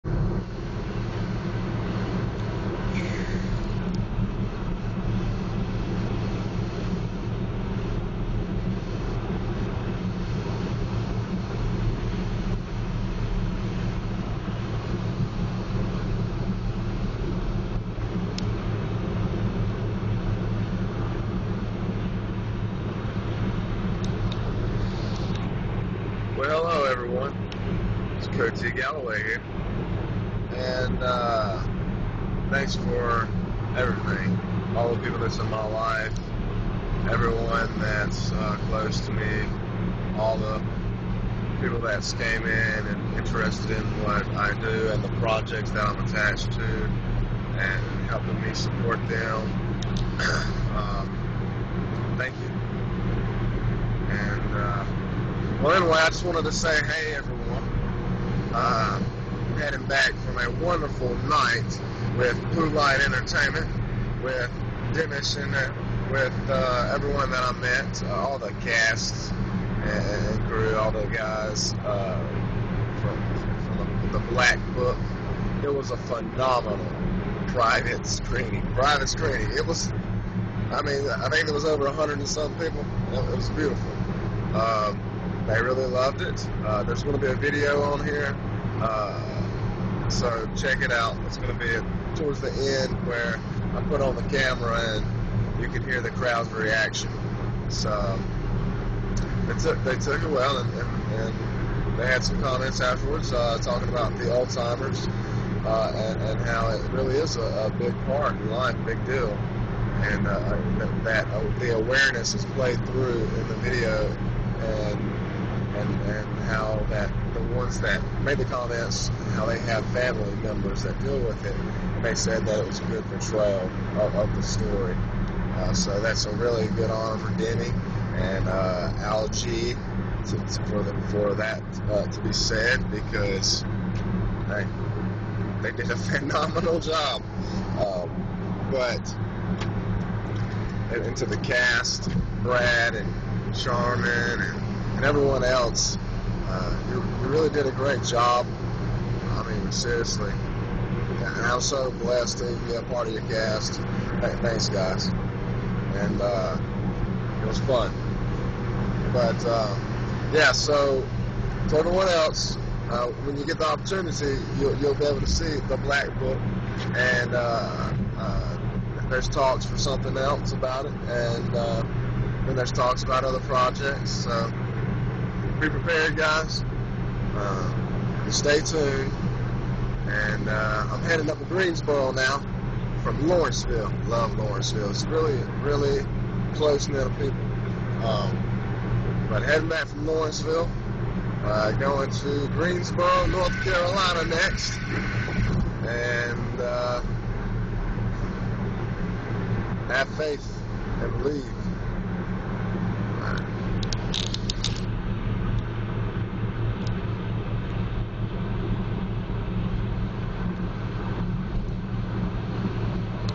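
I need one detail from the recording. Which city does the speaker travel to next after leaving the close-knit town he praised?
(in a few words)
Greensboro, North Carolina.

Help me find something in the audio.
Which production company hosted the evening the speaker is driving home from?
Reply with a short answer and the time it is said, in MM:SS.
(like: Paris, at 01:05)
Bluelite Entertainment, at 01:02.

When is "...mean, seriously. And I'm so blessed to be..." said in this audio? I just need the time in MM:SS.
02:29.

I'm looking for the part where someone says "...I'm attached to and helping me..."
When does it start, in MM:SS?
00:45.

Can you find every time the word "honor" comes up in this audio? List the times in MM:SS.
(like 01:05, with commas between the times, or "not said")
02:06.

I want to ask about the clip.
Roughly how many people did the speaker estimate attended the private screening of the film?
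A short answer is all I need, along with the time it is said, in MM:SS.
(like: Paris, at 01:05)
over 100, at 01:21.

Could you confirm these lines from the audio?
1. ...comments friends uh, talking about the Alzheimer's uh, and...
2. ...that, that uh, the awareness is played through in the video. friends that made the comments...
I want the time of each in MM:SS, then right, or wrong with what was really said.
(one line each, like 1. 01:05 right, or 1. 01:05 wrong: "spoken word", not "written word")
1. 01:42 wrong: "afterwards", not "friends"
2. 01:50 right.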